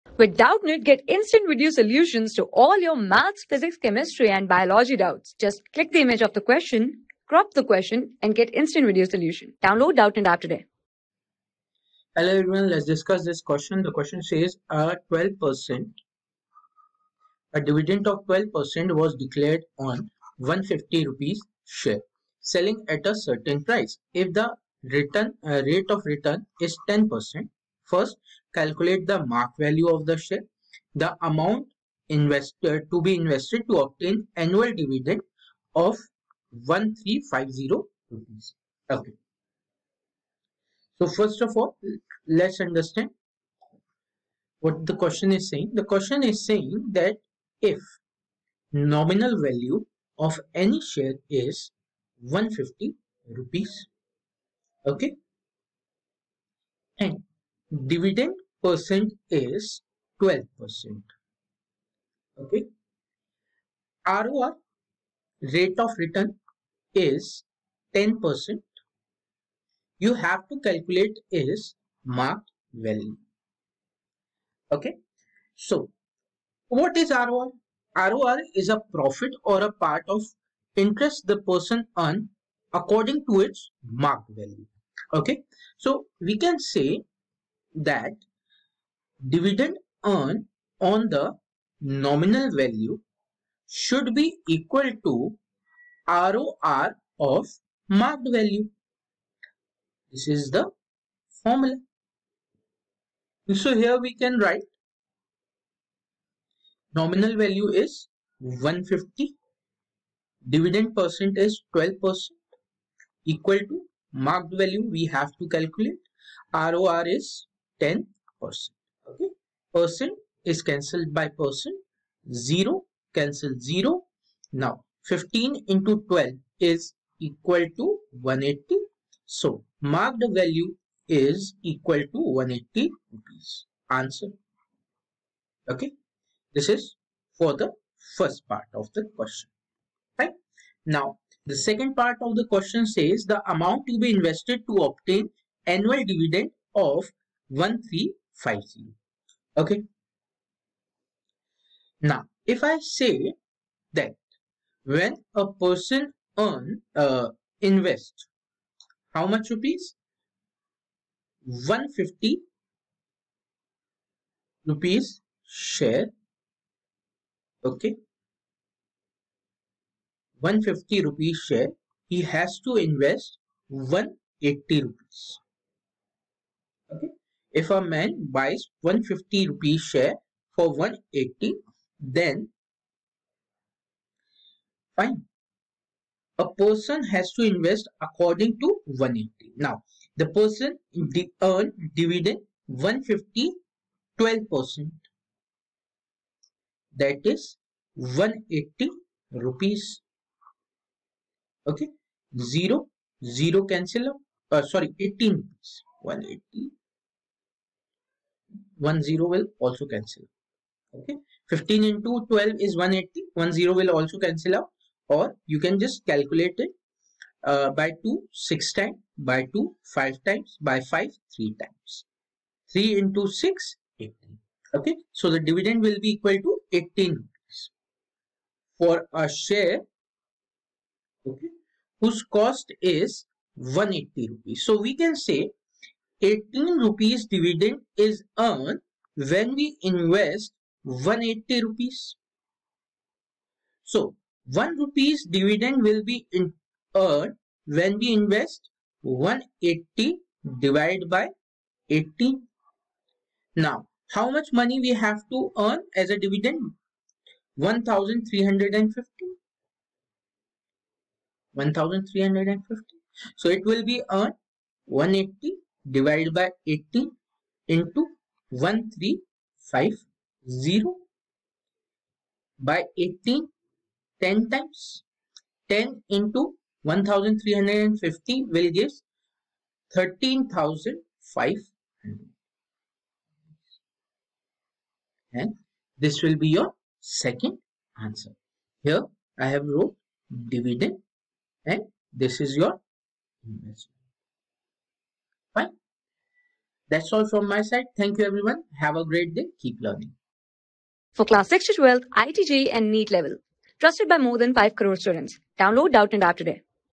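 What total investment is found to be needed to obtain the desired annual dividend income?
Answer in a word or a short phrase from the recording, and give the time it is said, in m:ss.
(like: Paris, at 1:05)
13500, at 4:39.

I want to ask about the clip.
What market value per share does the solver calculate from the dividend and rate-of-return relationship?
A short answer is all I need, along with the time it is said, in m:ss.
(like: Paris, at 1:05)
180 rupees, at 2:09.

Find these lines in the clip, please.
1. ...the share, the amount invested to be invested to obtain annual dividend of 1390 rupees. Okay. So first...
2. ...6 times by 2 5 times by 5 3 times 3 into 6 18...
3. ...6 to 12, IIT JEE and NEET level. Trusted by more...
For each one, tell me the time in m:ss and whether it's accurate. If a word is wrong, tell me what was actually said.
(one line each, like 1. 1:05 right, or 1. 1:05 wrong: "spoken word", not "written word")
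1. 0:30 wrong: "1350", not "1390"
2. 3:38 right
3. 5:01 right.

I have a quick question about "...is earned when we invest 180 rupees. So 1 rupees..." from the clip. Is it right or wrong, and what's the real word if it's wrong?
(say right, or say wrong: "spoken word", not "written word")
right.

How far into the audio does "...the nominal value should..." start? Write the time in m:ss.
1:31.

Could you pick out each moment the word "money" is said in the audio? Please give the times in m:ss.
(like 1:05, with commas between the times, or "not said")
4:14.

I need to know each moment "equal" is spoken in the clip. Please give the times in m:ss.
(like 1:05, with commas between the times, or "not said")
1:34, 1:53, 2:07, 2:11, 3:46.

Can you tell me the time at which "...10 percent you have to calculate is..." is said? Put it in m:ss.
1:07.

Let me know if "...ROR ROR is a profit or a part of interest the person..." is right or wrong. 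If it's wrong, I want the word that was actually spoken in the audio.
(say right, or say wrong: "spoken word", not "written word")
right.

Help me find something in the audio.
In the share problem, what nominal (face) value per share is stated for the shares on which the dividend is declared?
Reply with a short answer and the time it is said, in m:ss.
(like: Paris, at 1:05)
150 rupees, at 0:48.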